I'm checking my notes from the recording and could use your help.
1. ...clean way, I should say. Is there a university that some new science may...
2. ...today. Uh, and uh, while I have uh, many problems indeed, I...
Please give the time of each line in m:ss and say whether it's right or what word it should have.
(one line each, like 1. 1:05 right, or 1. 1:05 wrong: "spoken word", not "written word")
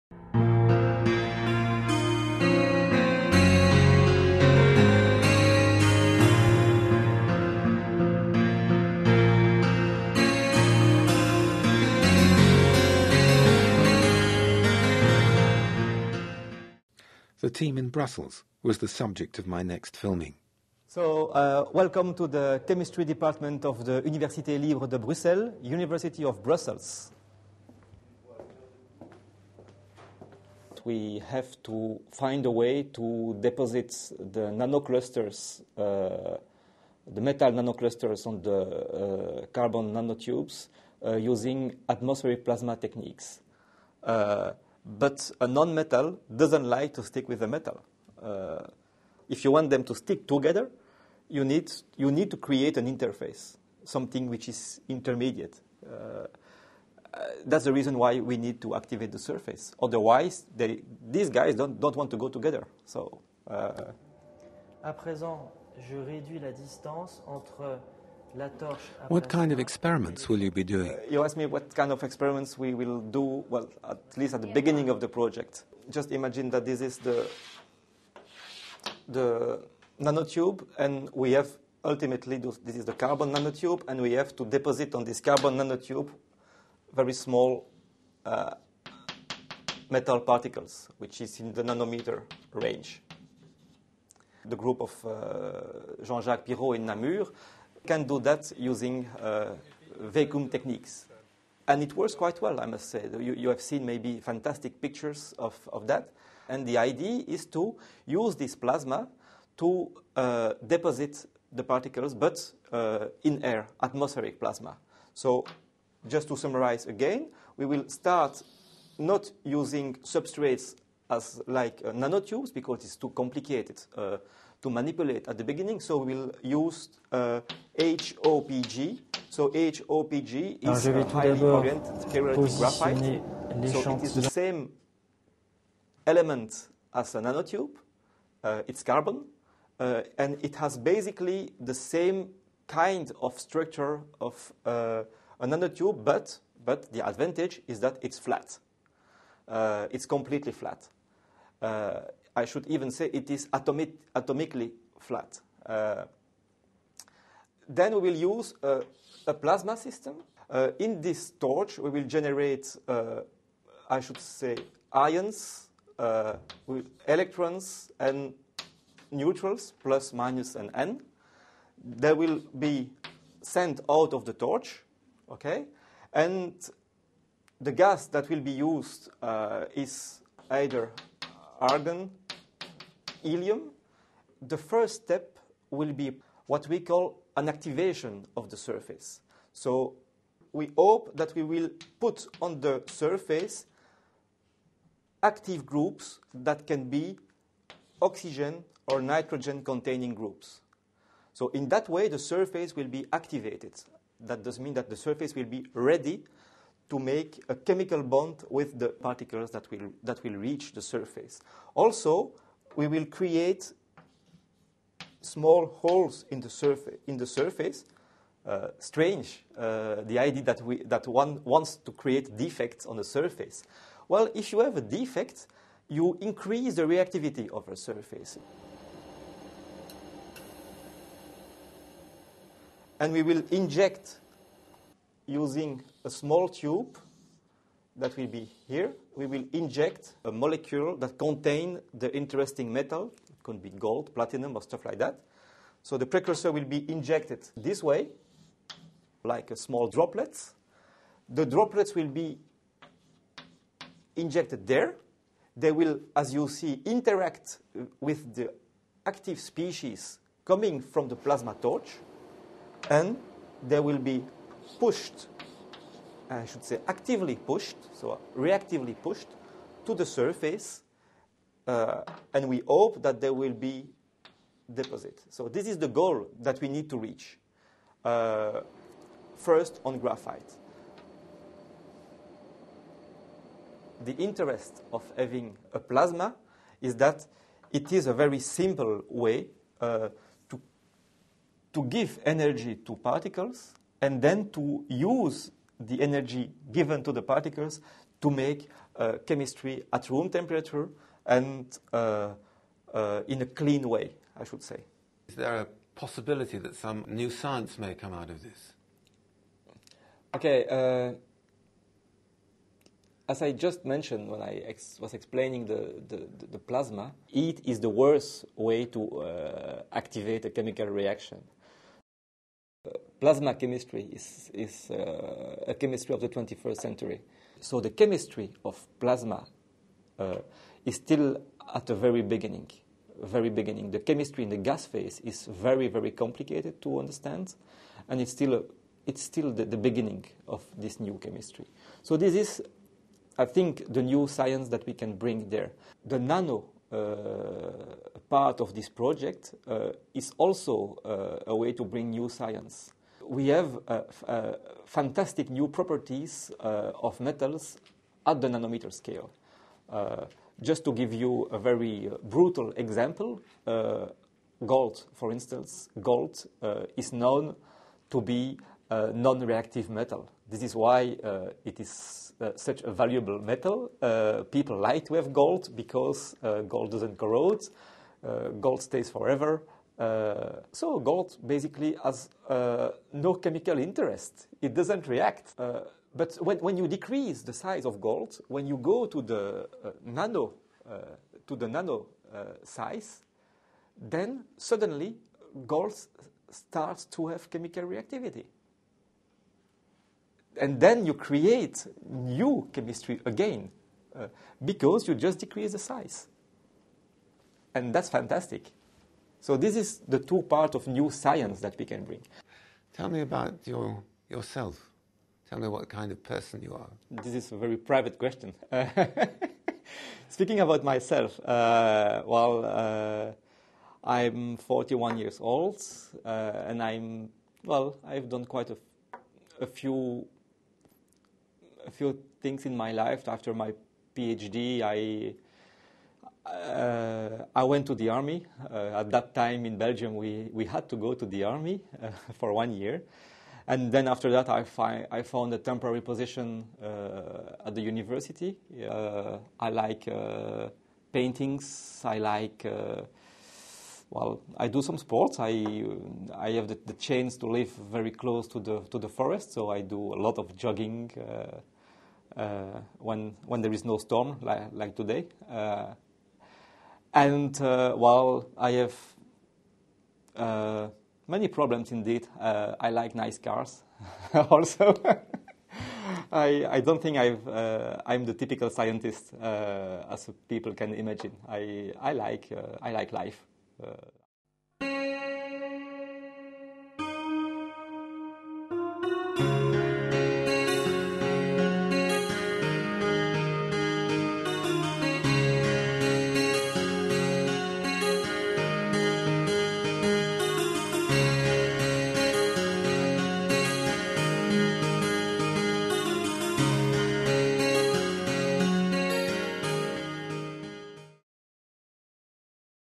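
1. 5:03 wrong: "possibility", not "university"
2. 7:44 right.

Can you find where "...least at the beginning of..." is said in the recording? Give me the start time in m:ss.
1:14.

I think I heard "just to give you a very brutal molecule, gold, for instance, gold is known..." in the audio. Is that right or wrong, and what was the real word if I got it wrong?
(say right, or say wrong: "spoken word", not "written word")
wrong: "example", not "molecule".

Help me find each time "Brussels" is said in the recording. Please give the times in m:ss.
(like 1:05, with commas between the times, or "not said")
0:17, 0:26.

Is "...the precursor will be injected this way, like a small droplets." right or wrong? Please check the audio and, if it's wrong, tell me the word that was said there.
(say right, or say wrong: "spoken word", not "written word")
right.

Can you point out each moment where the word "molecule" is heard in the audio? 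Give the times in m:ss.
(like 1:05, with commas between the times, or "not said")
4:00.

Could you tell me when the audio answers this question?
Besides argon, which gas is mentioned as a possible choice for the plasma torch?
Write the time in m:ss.
3:03.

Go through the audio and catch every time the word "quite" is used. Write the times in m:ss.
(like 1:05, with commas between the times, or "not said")
1:42, 7:08.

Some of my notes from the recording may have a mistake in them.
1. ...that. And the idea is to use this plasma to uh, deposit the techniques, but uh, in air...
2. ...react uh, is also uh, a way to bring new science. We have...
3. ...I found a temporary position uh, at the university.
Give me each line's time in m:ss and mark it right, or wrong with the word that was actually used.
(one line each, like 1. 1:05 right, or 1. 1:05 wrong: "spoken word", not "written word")
1. 1:45 wrong: "particles", not "techniques"
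2. 5:48 wrong: "project", not "react"
3. 7:25 right.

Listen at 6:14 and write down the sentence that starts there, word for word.
people like to have gold because gold doesn't corrode, gold stays forever.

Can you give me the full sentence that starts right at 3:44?
Well, if you have a defect, you increase the reactivity of a surface.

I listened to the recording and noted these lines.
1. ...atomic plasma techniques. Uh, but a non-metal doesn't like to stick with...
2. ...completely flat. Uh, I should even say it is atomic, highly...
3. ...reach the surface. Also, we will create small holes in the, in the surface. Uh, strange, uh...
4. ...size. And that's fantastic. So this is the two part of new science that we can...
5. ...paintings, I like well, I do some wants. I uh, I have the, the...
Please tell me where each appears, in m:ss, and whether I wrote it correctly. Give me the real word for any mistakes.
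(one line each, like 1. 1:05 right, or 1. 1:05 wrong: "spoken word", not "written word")
1. 0:41 wrong: "atmospheric", not "atomic"
2. 2:30 wrong: "atomically", not "highly"
3. 3:30 right
4. 6:45 right
5. 7:31 wrong: "sports", not "wants".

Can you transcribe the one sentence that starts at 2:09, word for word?
So HOPG Alors is a highly oriented pyrolytic graphite.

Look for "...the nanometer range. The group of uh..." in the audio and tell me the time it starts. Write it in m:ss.
1:31.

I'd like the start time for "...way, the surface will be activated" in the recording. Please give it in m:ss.
3:21.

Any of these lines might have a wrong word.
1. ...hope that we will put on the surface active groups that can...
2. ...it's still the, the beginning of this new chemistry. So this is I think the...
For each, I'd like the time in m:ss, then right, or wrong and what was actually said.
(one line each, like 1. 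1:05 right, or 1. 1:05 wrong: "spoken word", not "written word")
1. 3:10 right
2. 5:39 right.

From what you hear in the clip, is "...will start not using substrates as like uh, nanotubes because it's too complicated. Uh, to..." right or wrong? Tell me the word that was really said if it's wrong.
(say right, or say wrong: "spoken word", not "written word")
right.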